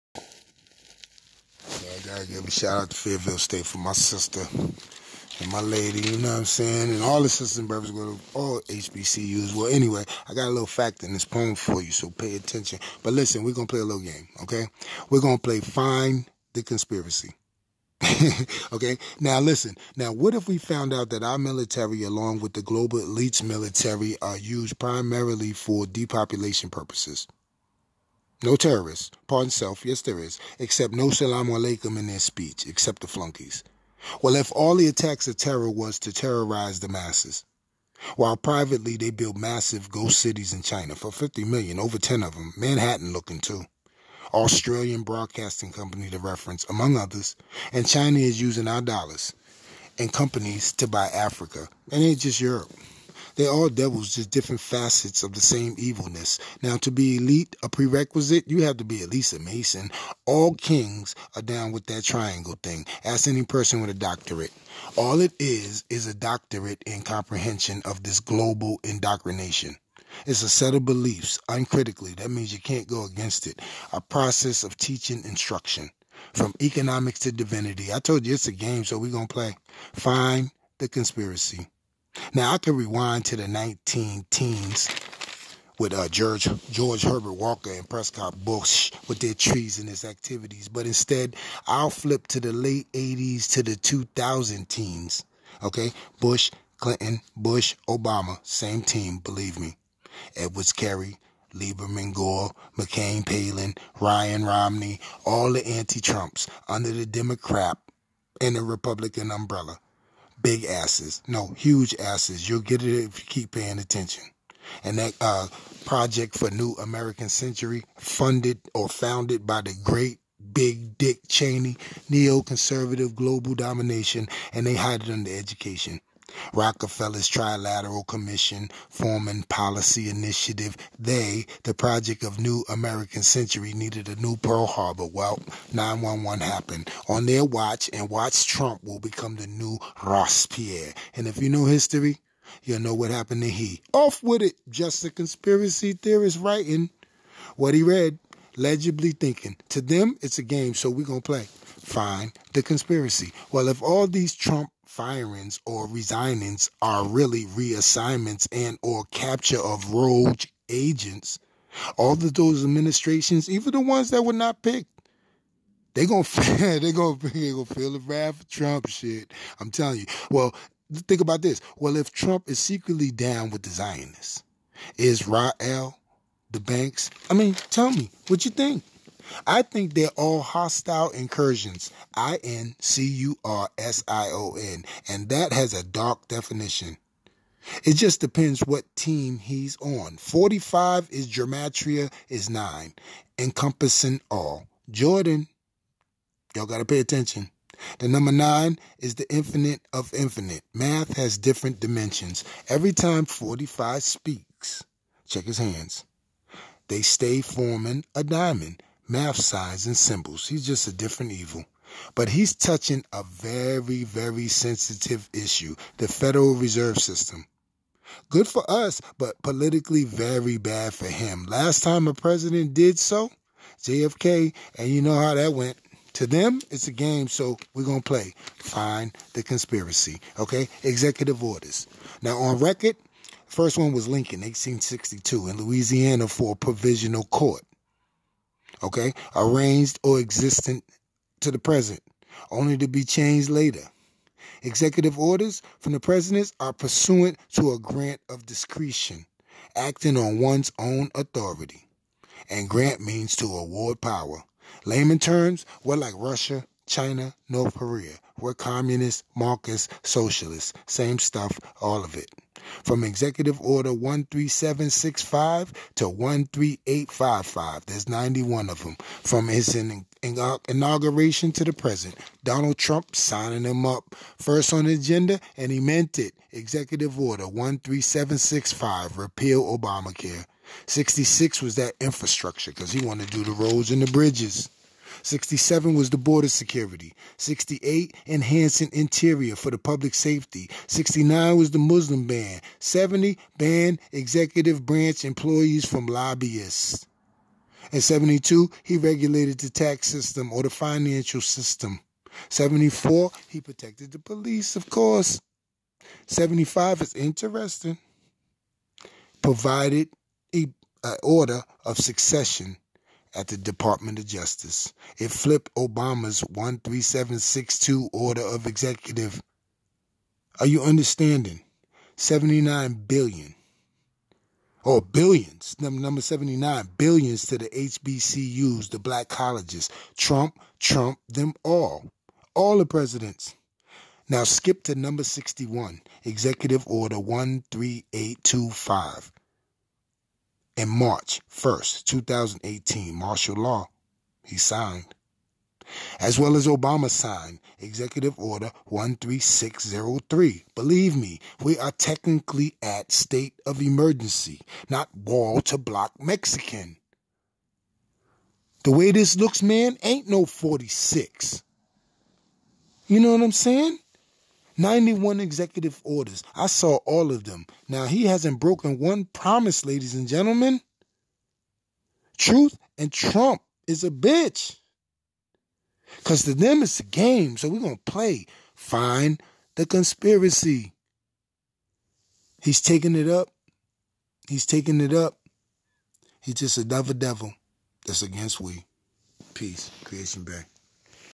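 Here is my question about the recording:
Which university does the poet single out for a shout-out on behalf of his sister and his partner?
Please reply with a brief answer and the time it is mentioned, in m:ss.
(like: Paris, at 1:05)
Fayetteville State, at 0:02.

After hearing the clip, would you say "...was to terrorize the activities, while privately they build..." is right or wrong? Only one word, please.
wrong.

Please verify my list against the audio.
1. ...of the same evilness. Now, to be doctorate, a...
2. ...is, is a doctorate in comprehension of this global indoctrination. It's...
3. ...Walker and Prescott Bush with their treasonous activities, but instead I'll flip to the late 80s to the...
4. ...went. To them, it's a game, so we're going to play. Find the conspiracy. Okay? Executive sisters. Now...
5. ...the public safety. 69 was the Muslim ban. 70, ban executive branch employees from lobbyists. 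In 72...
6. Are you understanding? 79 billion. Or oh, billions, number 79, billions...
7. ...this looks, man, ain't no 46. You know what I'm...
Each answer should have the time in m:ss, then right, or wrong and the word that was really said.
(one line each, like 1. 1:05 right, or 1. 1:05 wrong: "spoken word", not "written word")
1. 0:55 wrong: "elite", not "doctorate"
2. 1:05 right
3. 1:27 right
4. 3:45 wrong: "orders", not "sisters"
5. 4:49 right
6. 5:20 right
7. 5:59 right.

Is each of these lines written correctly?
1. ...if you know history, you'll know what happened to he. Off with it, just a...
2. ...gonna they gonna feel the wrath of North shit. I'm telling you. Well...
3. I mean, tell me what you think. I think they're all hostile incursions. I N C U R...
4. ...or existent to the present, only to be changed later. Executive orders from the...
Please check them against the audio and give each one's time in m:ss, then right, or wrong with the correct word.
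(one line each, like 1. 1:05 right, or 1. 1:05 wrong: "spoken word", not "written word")
1. 2:21 right
2. 2:46 wrong: "Trump", not "North"
3. 2:57 right
4. 4:00 right.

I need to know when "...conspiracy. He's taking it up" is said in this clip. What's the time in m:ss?
6:19.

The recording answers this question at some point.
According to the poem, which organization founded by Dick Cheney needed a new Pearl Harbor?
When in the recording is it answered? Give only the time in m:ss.
1:55.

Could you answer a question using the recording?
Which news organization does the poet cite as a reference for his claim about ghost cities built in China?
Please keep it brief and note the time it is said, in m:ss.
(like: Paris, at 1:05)
Australian Broadcasting Company, at 0:44.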